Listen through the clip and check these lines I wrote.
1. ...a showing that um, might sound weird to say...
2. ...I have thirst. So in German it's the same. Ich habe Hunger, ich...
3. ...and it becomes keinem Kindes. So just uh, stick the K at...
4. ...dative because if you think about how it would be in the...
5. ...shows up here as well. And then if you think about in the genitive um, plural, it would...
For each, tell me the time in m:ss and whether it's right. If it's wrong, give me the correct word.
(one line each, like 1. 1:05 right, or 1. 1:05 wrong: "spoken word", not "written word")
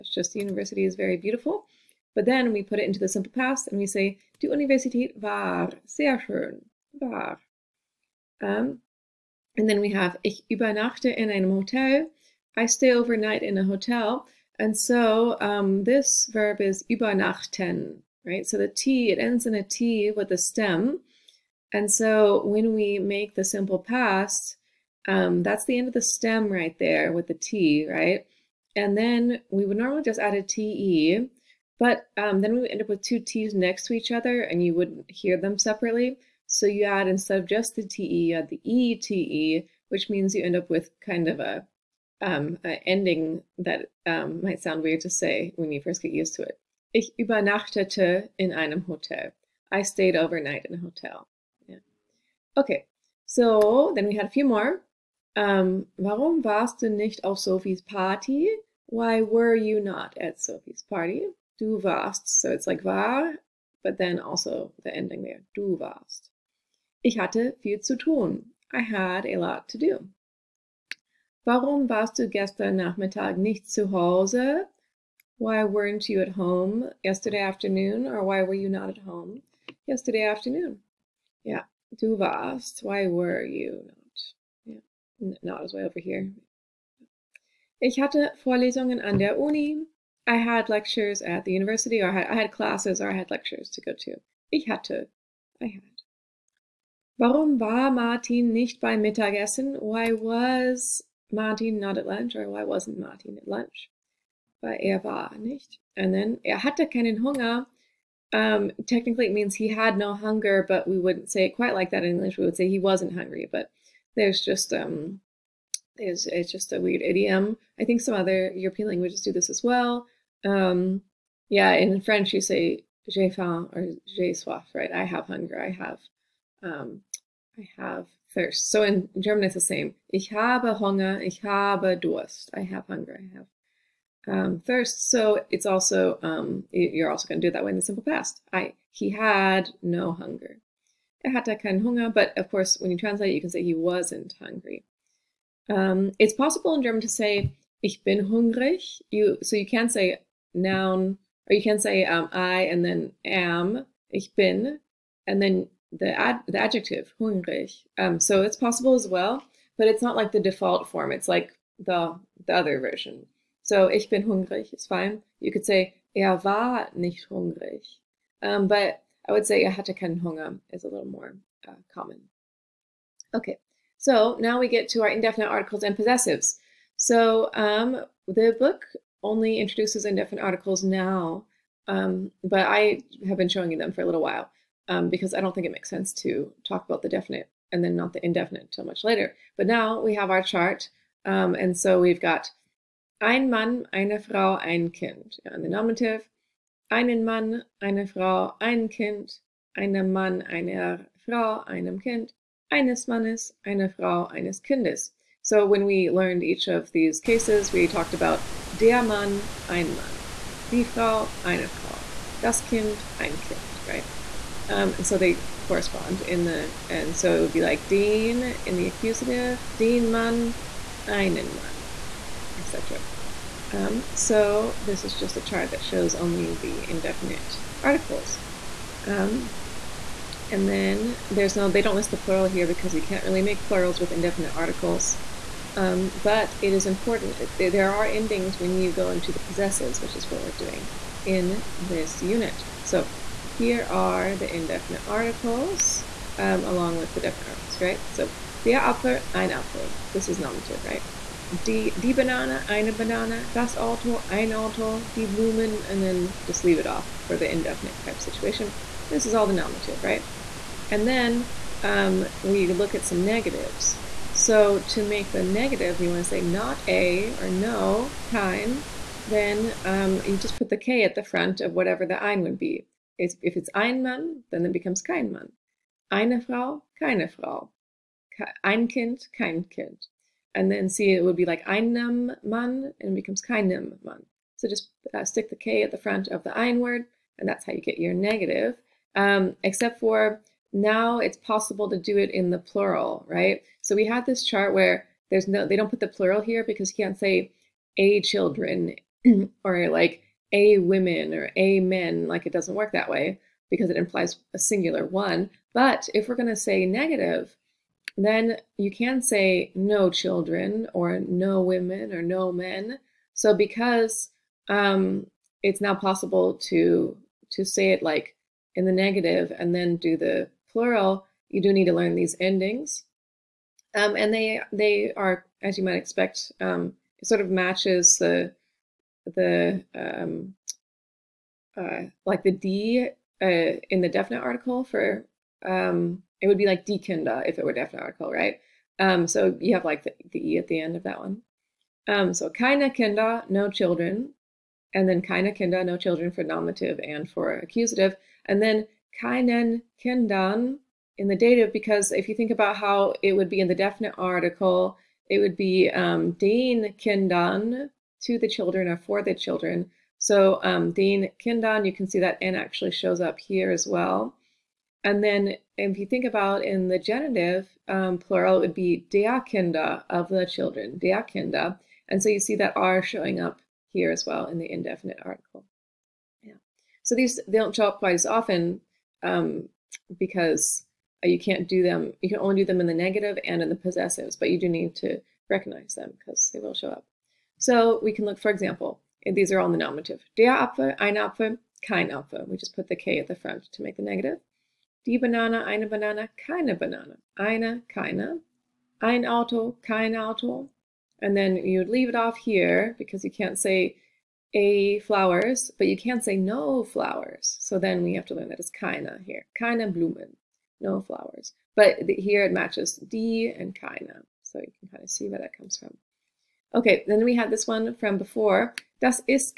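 1. 0:42 wrong: "ending", not "showing"
2. 2:07 right
3. 4:42 wrong: "Mann", not "Kindes"
4. 5:51 right
5. 6:02 right.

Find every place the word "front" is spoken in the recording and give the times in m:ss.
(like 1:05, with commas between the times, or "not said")
4:31, 4:45, 6:33.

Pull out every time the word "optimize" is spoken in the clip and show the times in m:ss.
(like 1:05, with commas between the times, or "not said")
not said.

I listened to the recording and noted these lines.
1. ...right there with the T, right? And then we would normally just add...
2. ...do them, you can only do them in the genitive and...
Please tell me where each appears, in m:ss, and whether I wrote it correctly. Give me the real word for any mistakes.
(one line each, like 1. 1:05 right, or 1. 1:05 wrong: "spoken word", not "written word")
1. 0:26 right
2. 6:21 wrong: "negative", not "genitive".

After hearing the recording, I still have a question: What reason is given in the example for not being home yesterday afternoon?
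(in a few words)
lectures at the university.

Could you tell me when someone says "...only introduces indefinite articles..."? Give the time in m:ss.
2:59.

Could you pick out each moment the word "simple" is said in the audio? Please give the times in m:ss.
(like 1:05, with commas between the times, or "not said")
0:03, 0:23, 2:17.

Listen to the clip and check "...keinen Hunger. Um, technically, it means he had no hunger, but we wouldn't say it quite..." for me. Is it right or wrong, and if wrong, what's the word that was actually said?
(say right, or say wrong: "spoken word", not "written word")
right.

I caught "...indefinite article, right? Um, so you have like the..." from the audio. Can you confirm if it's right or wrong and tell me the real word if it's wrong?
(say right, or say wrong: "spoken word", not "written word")
wrong: "definite", not "indefinite".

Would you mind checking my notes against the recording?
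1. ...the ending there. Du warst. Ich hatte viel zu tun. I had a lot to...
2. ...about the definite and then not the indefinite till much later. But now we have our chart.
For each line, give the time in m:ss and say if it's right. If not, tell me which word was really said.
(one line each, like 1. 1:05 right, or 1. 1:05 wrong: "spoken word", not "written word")
1. 1:04 right
2. 3:06 right.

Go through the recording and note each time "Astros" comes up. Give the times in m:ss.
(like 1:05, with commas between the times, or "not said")
not said.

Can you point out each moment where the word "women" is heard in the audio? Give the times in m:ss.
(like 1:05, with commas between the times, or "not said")
5:00, 5:11.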